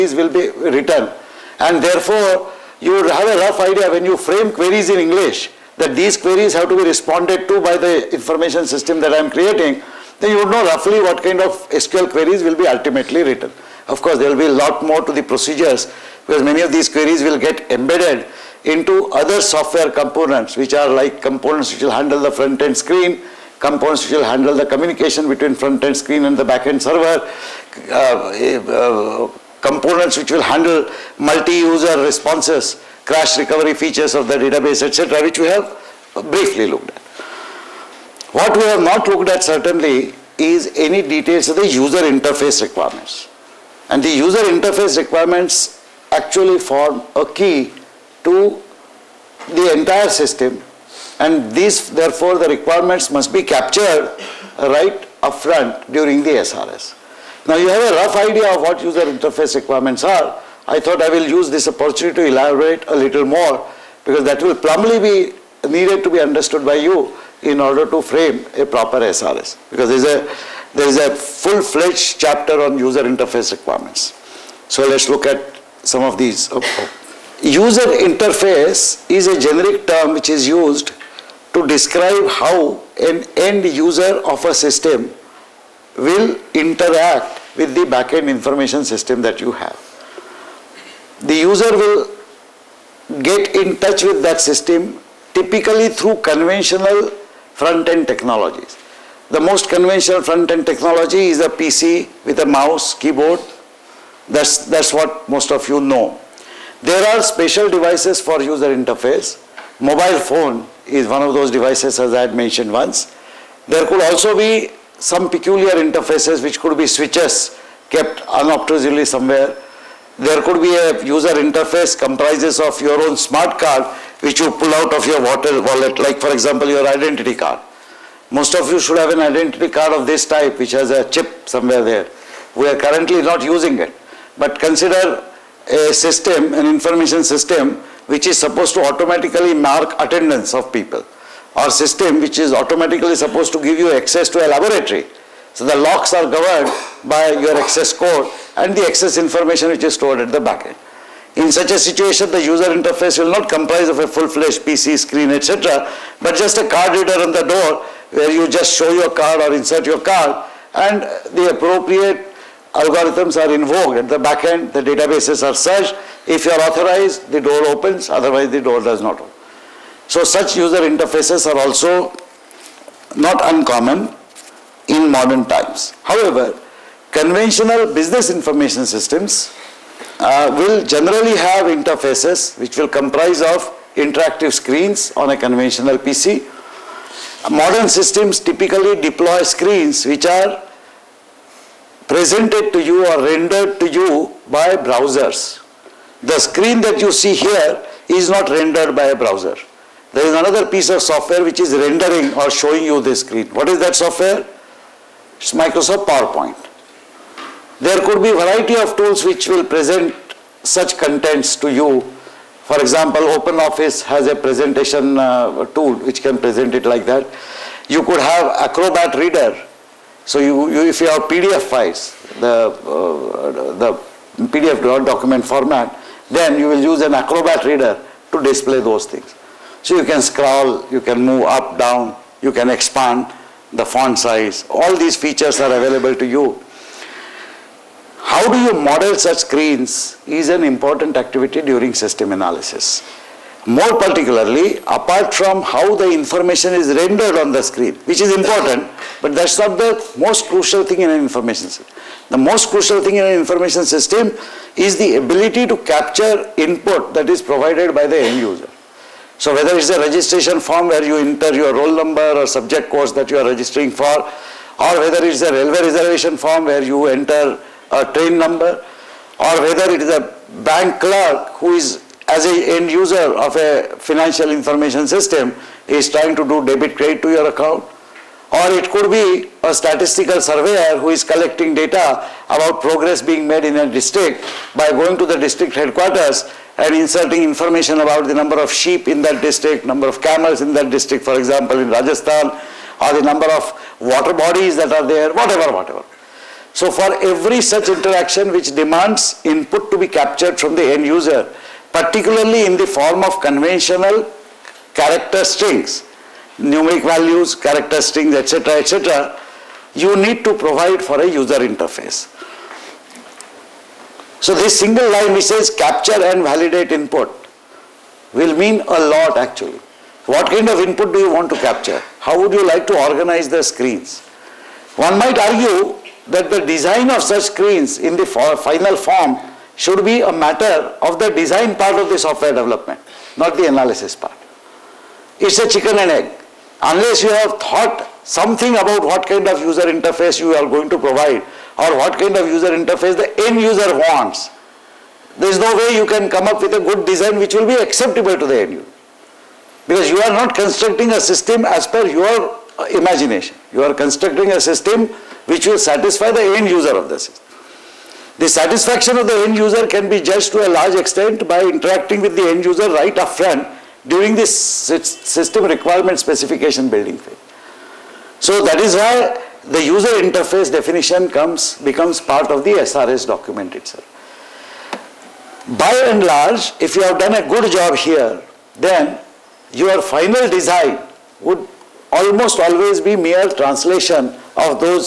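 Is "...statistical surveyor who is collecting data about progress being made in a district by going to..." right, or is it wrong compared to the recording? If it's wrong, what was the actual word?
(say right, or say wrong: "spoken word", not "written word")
right.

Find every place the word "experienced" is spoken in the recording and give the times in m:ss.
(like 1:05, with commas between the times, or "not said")
not said.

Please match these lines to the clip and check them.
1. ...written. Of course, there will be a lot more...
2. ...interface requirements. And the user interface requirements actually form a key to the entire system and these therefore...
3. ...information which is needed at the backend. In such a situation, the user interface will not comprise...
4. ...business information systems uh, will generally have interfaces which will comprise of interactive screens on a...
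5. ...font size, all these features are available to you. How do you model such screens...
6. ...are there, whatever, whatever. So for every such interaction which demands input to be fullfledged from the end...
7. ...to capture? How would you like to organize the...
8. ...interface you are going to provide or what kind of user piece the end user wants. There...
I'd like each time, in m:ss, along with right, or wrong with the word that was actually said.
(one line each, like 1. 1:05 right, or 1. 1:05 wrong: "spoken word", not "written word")
1. 0:13 right
2. 0:41 right
3. 2:29 wrong: "stored", not "needed"
4. 2:57 right
5. 3:53 right
6. 4:54 wrong: "captured", not "fullfledged"
7. 5:21 right
8. 5:39 wrong: "interface", not "piece".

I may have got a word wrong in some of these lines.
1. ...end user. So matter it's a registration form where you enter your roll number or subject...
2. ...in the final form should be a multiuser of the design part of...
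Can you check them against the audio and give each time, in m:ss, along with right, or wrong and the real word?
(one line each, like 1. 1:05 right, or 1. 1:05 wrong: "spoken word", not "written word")
1. 4:18 wrong: "whether", not "matter"
2. 5:27 wrong: "matter", not "multiuser".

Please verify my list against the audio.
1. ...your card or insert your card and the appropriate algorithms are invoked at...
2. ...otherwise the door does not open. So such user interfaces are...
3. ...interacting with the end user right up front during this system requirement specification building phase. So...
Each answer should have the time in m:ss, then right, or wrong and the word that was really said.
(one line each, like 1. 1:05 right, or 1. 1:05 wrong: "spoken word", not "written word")
1. 2:38 right
2. 2:48 right
3. 6:01 right.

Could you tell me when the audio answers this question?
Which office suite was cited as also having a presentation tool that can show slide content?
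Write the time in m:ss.
3:33.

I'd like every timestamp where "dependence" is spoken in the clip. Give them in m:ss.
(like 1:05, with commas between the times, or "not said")
not said.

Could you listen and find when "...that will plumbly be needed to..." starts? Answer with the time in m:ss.
1:04.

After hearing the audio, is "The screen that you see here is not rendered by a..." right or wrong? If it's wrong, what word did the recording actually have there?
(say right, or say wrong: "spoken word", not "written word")
right.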